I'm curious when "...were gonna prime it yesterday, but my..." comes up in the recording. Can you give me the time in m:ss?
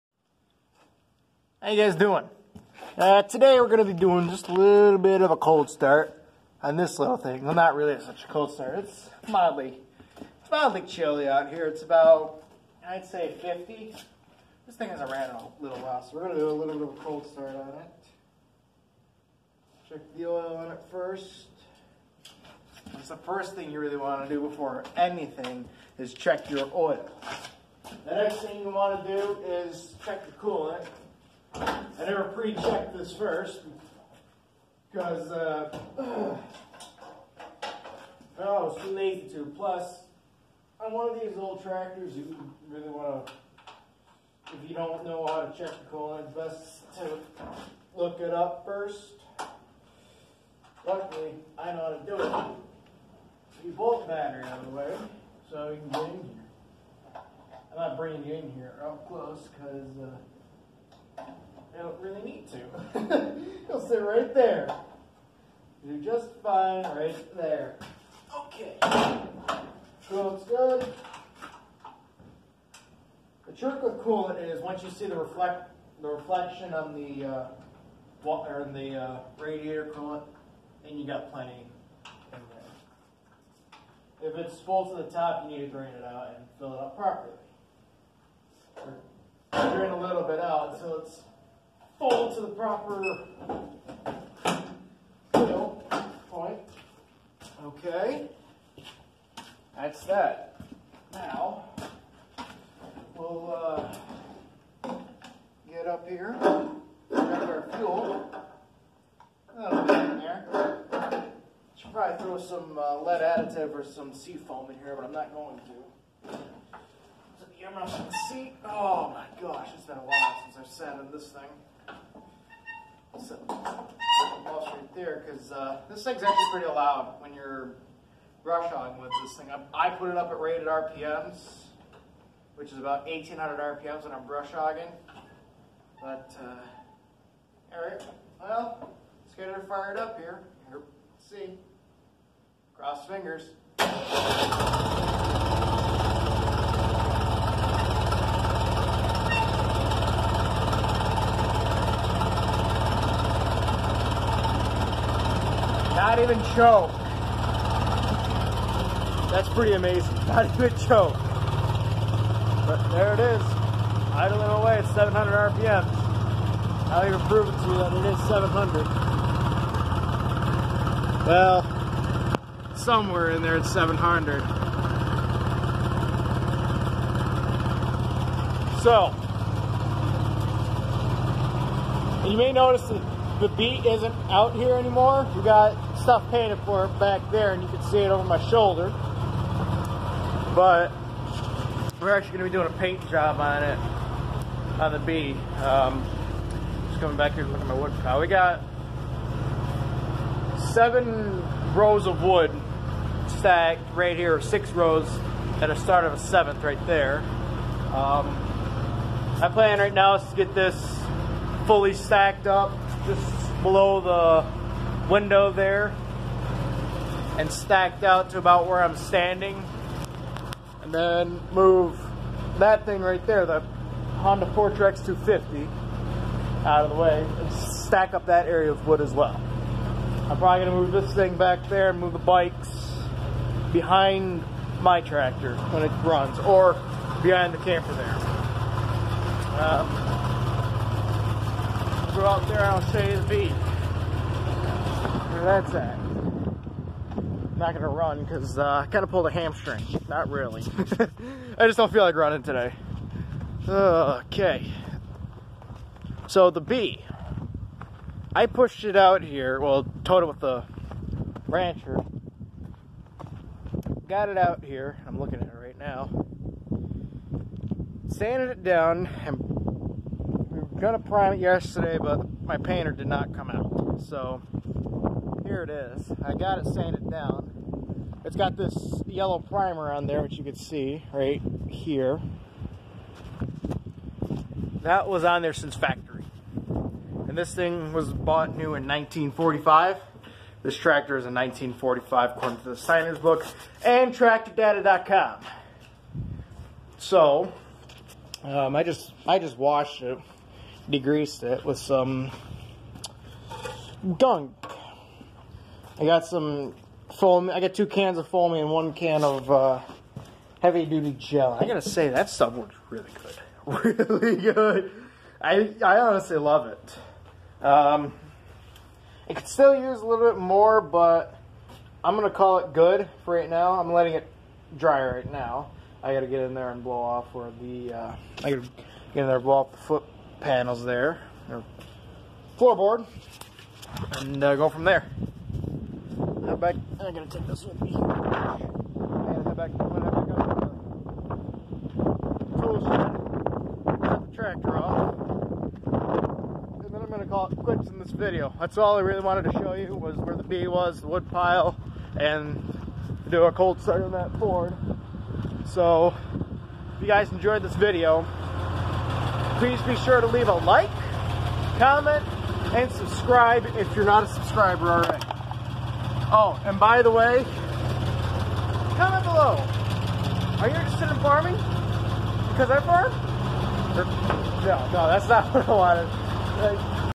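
4:30.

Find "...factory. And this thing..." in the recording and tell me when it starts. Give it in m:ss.
4:45.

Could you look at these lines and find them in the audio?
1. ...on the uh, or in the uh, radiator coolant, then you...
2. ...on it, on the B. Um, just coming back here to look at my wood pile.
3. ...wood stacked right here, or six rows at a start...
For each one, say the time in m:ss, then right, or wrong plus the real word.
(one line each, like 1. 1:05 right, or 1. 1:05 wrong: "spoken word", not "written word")
1. 1:16 right
2. 3:13 right
3. 3:22 right.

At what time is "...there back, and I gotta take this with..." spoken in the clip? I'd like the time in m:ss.
5:34.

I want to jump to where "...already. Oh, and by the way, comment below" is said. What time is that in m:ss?
6:04.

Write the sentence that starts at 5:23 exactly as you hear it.
I'm letting it dry right now.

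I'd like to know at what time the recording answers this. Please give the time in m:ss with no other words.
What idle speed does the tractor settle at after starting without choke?
2:44.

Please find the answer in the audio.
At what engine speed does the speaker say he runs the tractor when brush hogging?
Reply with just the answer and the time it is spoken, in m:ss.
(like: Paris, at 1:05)
1800 RPM, at 2:13.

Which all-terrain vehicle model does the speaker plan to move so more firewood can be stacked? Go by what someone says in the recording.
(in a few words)
Honda FourTrax 250.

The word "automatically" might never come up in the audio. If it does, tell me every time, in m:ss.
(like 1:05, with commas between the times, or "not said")
not said.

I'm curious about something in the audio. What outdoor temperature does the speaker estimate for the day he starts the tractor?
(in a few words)
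50.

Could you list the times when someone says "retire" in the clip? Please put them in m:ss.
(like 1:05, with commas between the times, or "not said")
not said.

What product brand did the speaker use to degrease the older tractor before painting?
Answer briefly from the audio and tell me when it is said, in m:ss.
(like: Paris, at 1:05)
Gunk, at 5:04.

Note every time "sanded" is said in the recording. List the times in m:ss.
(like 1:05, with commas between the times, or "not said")
4:28, 4:36.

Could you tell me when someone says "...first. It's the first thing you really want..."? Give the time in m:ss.
0:20.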